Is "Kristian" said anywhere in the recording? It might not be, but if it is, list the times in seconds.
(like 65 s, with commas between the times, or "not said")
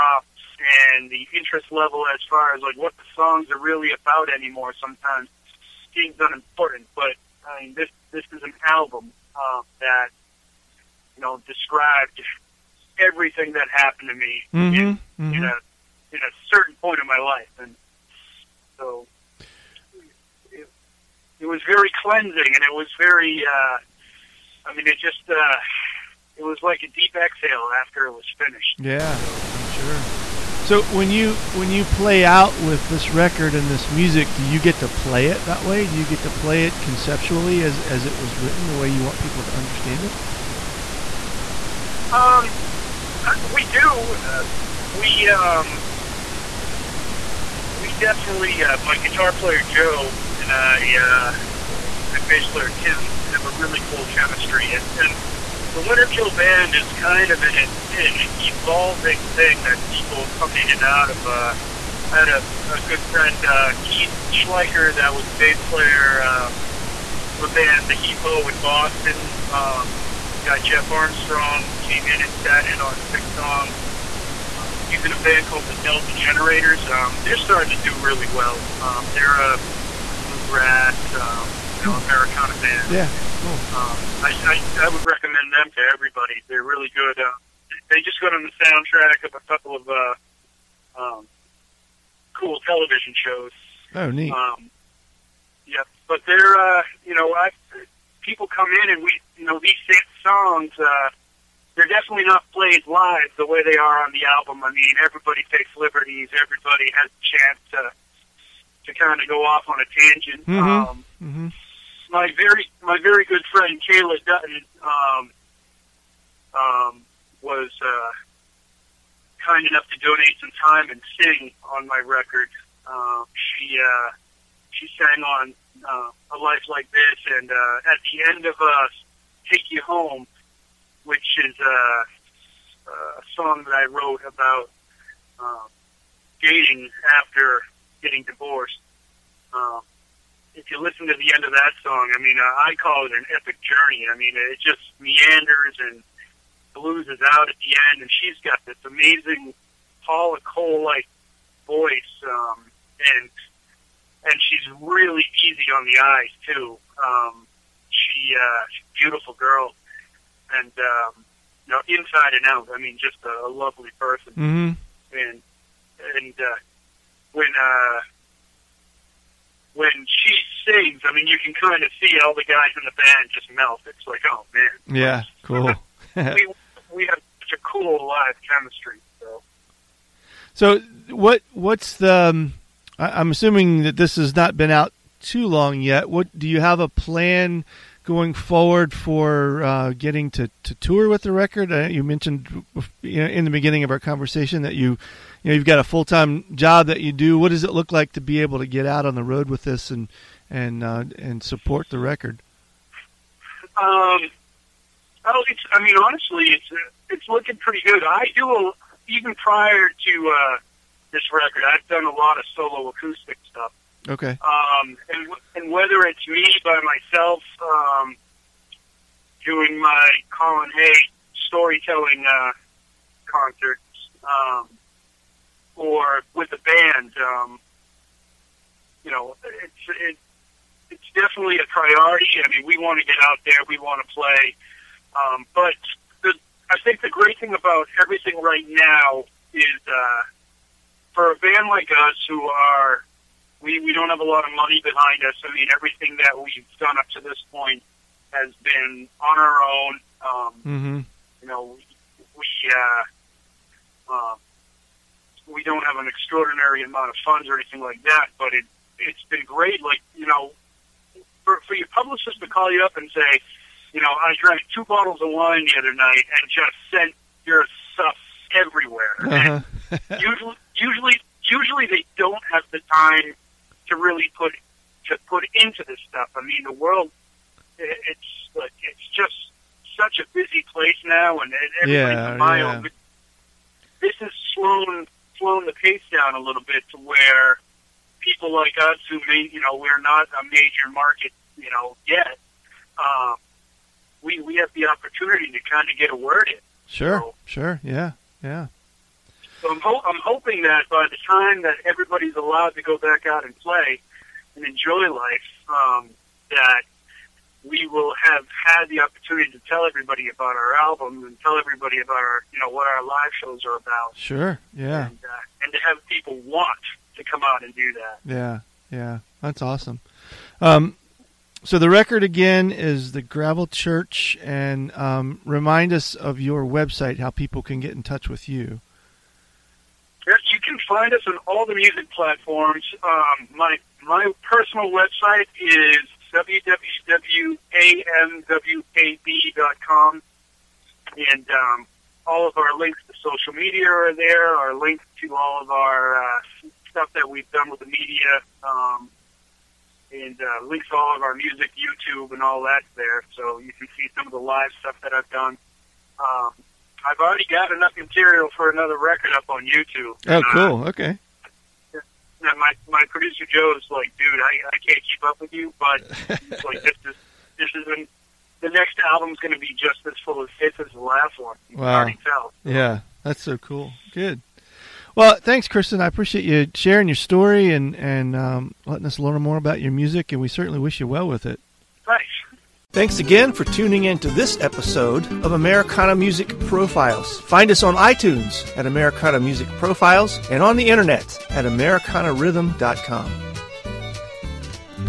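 375 s.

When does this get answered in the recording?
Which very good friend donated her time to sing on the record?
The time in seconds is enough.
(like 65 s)
113 s.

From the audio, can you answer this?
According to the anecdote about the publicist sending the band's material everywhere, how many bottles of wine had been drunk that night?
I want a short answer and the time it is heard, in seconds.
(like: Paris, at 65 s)
2, at 264 s.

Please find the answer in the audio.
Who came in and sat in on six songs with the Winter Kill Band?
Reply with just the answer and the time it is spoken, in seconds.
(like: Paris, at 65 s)
Jeff Armstrong, at 70 s.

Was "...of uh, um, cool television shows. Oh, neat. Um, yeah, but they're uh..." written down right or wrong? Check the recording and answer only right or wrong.
right.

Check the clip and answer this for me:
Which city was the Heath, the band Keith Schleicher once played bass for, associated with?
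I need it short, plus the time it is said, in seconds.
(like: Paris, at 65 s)
Boston, at 68 s.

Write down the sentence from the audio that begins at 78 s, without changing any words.
Um, they're a bluegrass, um, you know, hmm.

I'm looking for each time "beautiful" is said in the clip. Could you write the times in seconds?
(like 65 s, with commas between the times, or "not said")
158 s.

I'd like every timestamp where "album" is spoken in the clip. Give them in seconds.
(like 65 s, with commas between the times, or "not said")
8 s, 104 s, 310 s, 369 s.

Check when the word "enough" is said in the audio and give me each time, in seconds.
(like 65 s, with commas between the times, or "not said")
119 s, 357 s.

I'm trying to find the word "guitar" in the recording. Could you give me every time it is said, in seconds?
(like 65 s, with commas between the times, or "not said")
49 s.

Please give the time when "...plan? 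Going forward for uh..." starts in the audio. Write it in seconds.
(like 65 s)
186 s.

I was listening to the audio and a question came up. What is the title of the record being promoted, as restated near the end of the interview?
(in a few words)
The Gravel Church.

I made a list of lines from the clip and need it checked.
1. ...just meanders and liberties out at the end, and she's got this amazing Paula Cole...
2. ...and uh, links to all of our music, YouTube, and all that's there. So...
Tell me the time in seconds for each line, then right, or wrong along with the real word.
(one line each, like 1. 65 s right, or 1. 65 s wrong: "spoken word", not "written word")
1. 144 s wrong: "loses", not "liberties"
2. 350 s right.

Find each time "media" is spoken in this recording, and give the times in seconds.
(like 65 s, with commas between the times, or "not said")
343 s, 347 s.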